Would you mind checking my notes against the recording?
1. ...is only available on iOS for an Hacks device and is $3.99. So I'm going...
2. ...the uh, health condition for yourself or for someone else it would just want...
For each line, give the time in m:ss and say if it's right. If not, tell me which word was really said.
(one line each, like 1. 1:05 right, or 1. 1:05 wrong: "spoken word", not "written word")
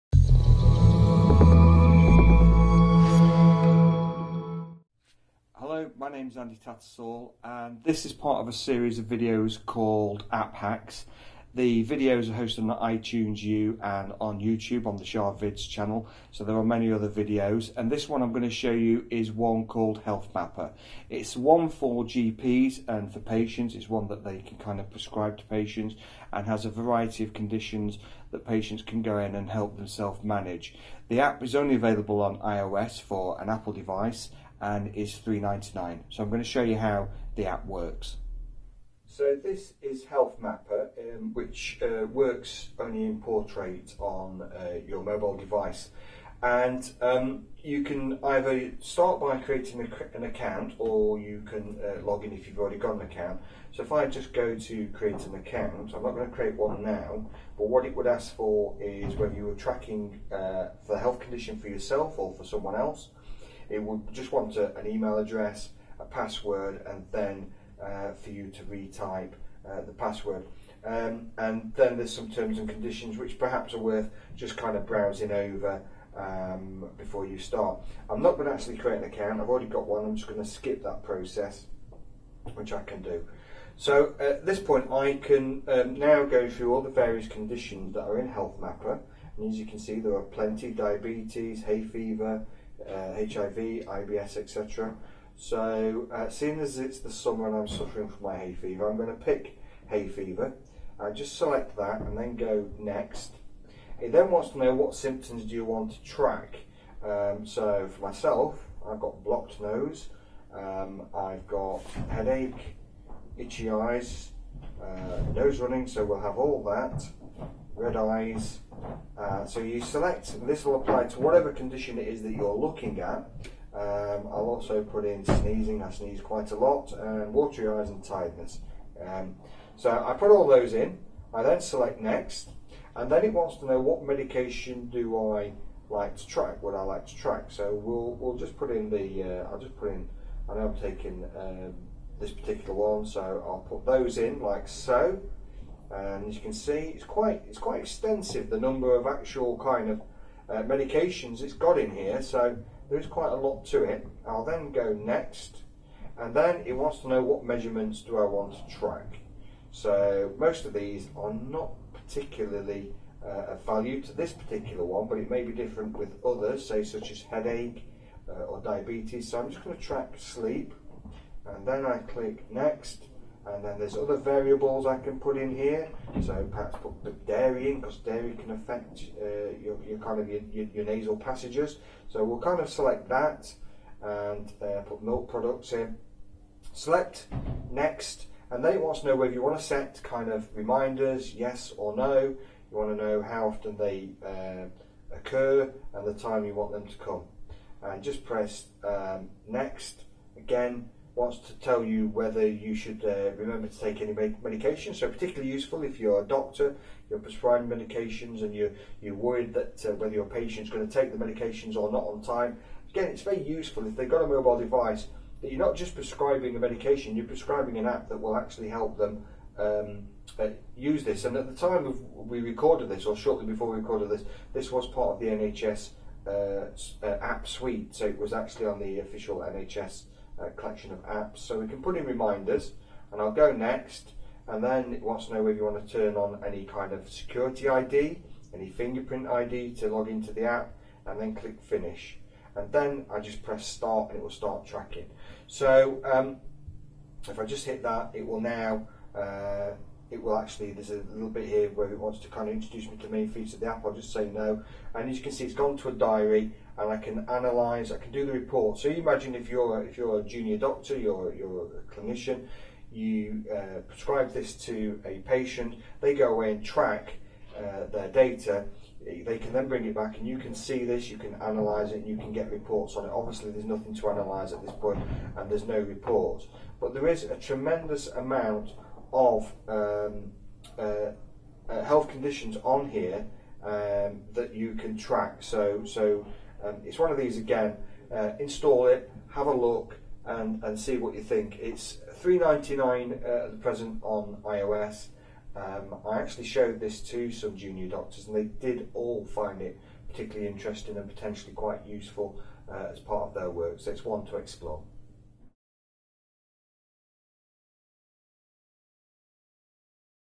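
1. 0:31 wrong: "Apple", not "Hacks"
2. 1:00 right.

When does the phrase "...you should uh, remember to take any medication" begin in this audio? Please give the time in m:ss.
3:22.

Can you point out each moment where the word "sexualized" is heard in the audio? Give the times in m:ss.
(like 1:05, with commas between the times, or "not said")
not said.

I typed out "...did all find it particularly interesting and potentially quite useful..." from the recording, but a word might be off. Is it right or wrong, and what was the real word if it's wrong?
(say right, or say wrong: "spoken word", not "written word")
right.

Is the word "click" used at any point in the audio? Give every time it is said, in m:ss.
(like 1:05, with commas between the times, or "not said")
2:51, 4:01.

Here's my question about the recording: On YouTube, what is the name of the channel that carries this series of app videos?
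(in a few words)
Sharvids.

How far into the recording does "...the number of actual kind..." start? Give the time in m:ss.
2:28.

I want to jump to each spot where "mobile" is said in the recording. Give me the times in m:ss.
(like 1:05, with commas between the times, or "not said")
0:45, 3:34.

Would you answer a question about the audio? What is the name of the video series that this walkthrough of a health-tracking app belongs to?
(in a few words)
App Hacks.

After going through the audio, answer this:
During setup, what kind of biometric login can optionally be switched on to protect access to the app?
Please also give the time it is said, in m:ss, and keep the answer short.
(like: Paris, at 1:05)
Fingerprint ID, at 3:58.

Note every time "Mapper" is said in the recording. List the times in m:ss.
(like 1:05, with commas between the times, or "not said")
0:20, 0:40, 1:28.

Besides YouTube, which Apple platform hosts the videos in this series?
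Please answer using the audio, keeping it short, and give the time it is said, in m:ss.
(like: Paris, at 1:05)
iTunes U, at 0:12.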